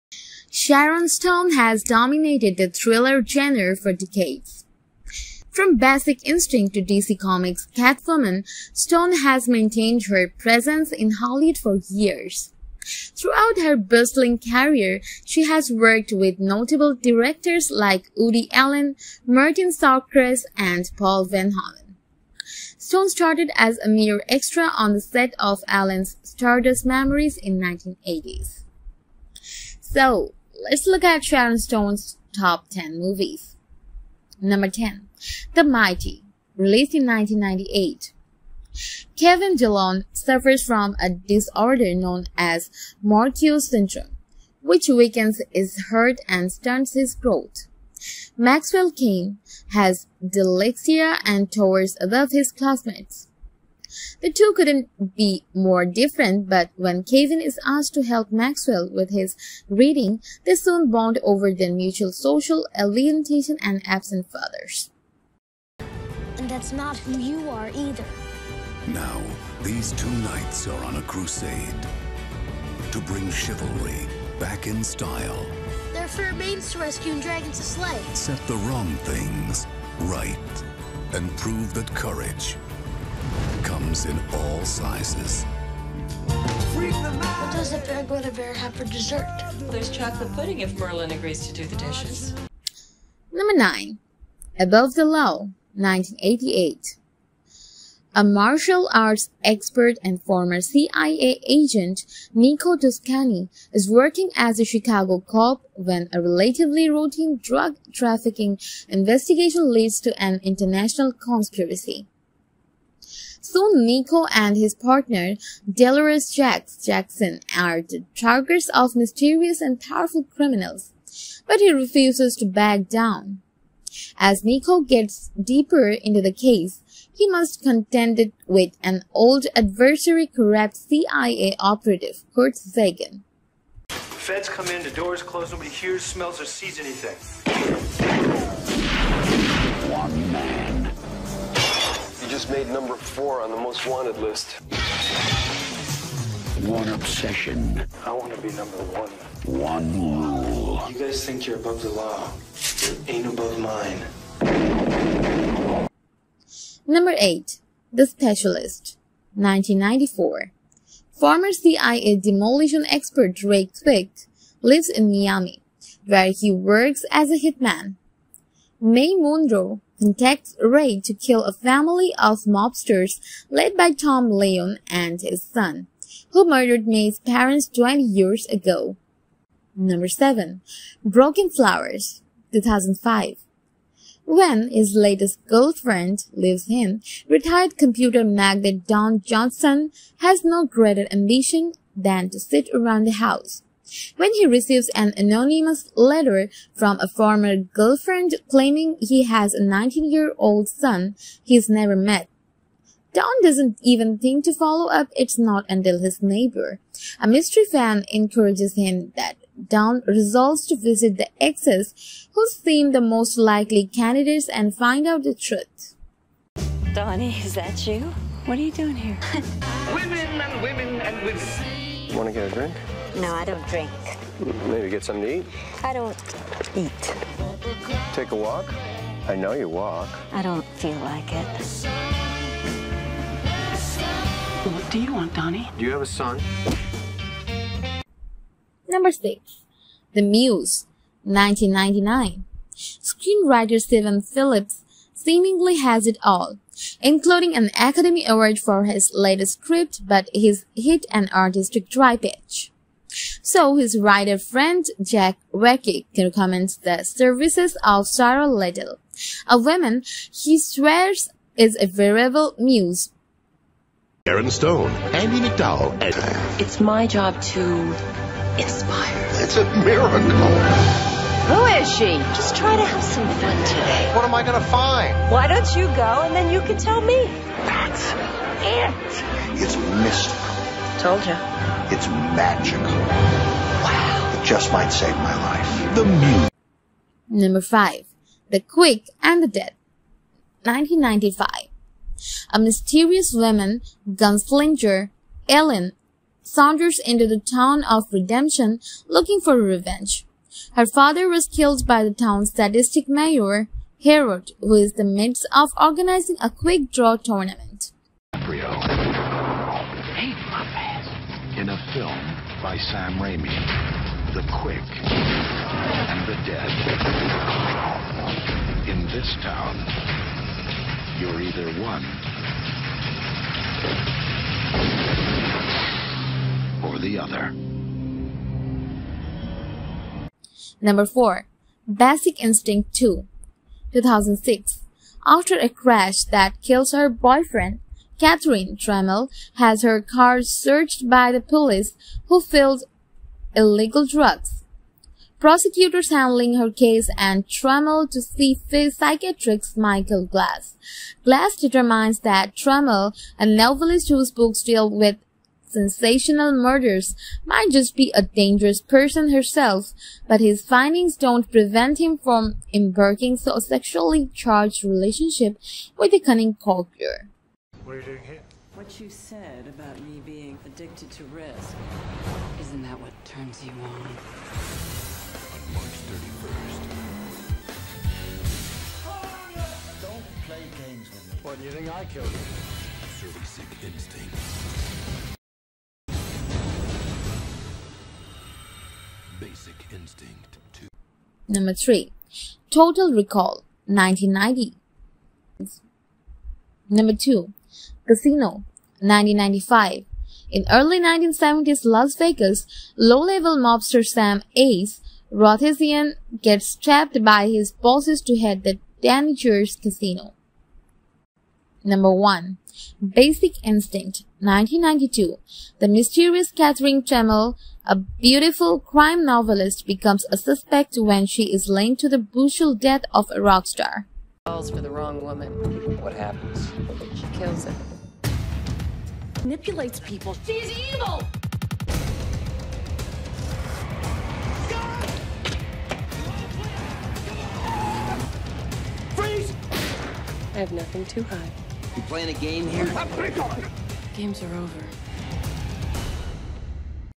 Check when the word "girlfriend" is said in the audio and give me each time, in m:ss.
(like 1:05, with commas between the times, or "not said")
3:05, 3:17.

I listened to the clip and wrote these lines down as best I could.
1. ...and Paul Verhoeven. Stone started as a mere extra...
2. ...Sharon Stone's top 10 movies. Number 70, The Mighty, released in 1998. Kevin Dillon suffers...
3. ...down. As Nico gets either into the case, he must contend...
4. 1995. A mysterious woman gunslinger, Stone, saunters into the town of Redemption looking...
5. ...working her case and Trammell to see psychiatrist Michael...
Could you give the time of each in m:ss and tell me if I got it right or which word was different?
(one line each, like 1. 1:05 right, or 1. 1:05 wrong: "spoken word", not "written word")
1. 0:20 right
2. 0:31 wrong: "10", not "70"
3. 2:02 wrong: "deeper", not "either"
4. 4:50 wrong: "Ellen", not "Stone"
5. 5:46 wrong: "handling", not "working".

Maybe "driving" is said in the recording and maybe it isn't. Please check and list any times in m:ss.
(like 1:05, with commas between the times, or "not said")
not said.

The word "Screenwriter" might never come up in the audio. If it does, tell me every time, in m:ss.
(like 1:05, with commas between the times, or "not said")
4:02.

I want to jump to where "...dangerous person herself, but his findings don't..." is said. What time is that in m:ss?
5:58.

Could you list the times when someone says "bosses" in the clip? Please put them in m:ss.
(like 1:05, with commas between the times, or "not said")
6:47.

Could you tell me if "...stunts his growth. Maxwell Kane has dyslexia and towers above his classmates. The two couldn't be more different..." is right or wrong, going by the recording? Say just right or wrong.
right.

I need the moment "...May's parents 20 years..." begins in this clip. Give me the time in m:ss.
2:56.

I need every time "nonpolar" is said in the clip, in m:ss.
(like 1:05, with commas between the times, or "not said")
not said.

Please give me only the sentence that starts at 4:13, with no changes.
So his writer friend Jack Warrick recommends the services of Sarah Little, a woman he swears is a variable muse.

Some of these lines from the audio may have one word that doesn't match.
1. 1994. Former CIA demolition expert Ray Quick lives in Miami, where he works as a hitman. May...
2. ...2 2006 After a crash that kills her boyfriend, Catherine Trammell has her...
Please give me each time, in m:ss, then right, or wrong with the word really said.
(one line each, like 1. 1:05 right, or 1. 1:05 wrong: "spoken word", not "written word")
1. 2:39 right
2. 5:32 right.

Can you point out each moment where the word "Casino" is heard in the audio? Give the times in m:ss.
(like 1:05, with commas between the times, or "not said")
6:38, 6:49.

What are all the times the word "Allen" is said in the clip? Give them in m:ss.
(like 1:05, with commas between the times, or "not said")
0:18, 0:25.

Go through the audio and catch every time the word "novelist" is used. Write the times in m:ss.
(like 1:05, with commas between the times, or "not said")
5:53, 6:59.